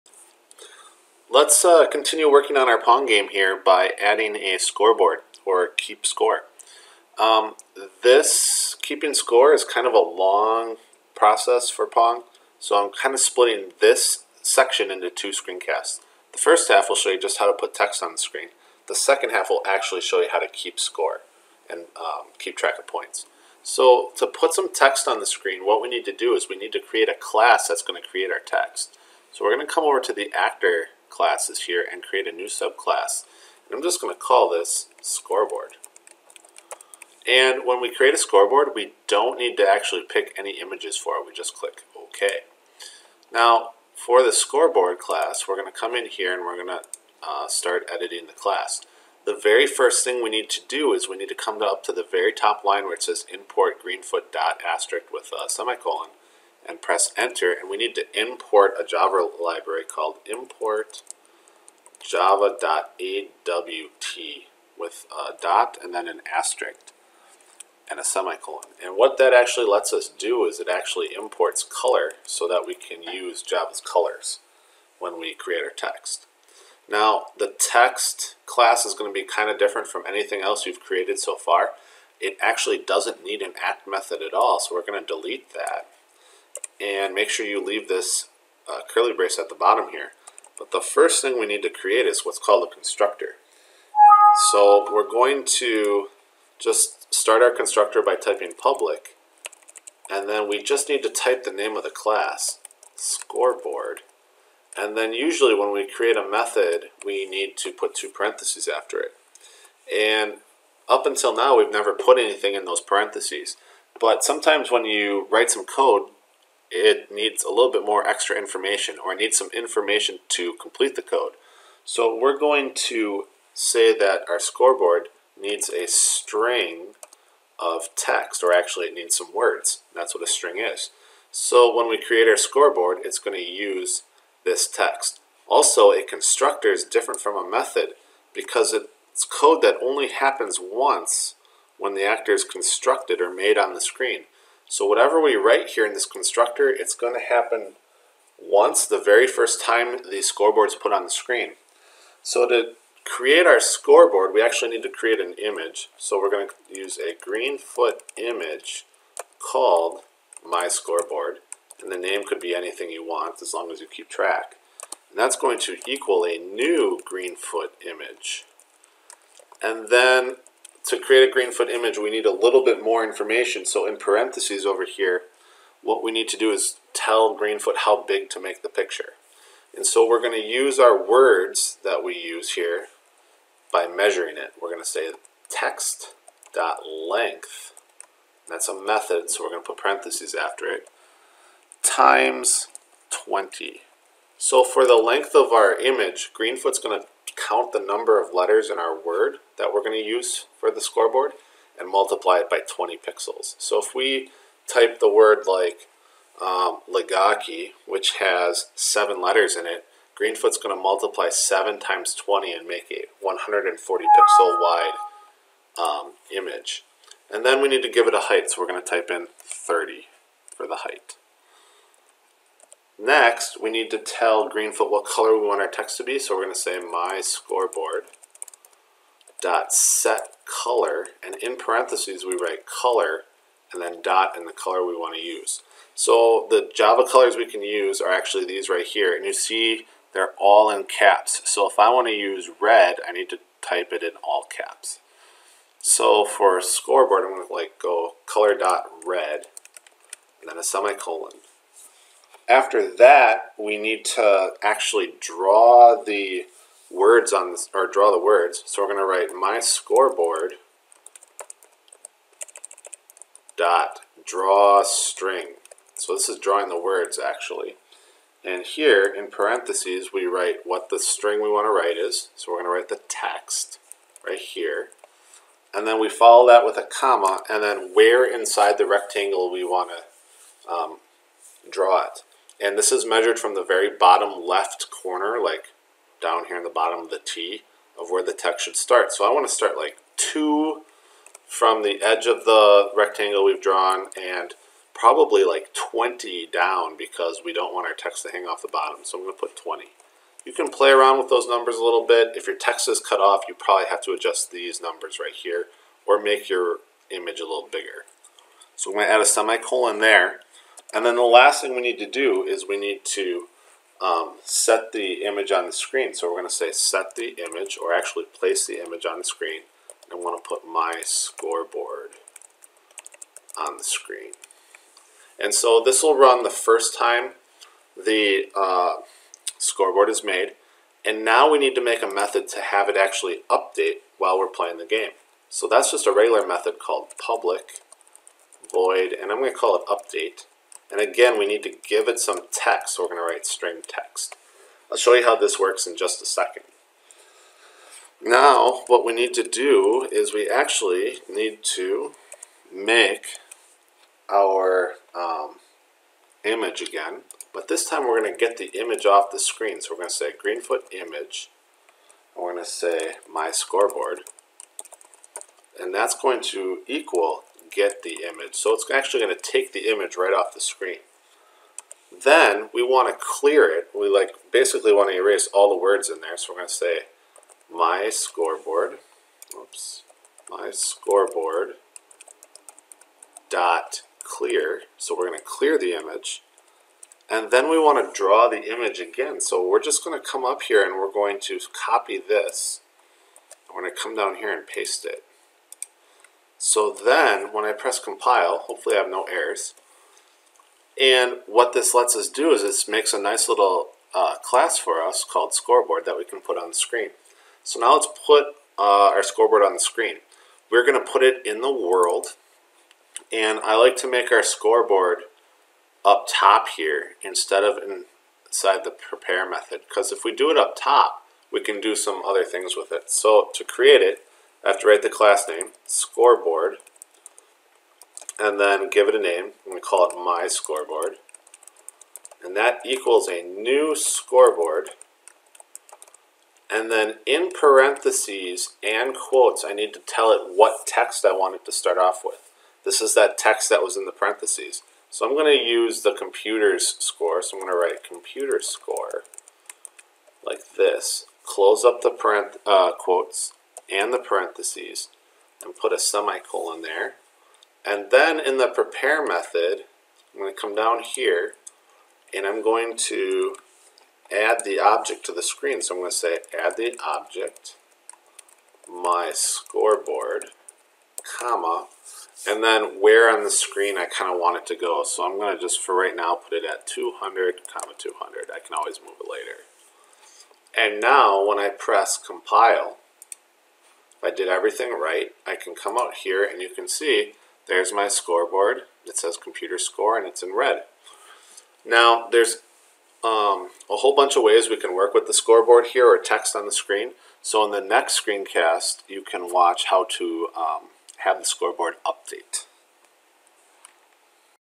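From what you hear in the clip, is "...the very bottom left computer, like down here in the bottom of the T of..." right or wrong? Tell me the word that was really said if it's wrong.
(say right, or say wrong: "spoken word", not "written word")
wrong: "corner", not "computer".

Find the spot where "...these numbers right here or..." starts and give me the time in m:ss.
5:04.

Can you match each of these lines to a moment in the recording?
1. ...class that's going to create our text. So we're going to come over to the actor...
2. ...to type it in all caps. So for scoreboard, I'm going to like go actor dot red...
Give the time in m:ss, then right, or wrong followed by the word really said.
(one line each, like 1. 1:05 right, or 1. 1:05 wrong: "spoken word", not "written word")
1. 0:27 right
2. 4:03 wrong: "color", not "actor".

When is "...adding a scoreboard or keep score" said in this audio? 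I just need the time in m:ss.
0:04.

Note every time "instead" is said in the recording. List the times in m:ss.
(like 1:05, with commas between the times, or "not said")
6:57.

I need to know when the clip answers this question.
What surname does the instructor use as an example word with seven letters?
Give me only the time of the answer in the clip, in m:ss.
3:26.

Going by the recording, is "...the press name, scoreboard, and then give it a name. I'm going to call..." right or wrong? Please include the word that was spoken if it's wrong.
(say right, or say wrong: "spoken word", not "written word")
wrong: "class", not "press".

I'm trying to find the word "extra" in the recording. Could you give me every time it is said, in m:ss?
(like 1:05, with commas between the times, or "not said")
1:58.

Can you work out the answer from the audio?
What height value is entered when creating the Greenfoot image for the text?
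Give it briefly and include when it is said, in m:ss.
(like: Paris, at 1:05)
30, at 3:39.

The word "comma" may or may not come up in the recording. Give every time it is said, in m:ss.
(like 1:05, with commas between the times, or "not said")
4:36, 7:51, 7:57.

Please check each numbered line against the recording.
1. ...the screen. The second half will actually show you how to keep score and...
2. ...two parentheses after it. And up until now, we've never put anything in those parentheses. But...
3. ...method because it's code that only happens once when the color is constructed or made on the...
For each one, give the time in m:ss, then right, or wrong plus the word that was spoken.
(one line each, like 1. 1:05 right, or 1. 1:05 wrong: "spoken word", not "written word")
1. 0:18 right
2. 1:47 right
3. 2:17 wrong: "actor", not "color".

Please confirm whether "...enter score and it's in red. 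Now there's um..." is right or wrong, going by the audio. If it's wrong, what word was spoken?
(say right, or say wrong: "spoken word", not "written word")
wrong: "computer", not "enter".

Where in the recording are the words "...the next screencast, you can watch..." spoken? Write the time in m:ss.
8:17.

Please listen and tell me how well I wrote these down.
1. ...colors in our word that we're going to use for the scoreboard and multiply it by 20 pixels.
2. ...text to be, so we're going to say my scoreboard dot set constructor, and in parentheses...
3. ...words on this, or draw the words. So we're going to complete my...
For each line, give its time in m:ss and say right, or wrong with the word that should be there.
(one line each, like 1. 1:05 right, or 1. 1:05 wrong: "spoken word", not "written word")
1. 3:18 wrong: "letters", not "colors"
2. 3:45 wrong: "color", not "constructor"
3. 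4:16 wrong: "write", not "complete".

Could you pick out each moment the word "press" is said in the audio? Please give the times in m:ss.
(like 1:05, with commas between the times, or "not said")
0:56, 6:37, 8:01.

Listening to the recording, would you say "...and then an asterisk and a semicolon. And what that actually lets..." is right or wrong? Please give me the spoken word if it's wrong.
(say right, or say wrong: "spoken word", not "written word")
right.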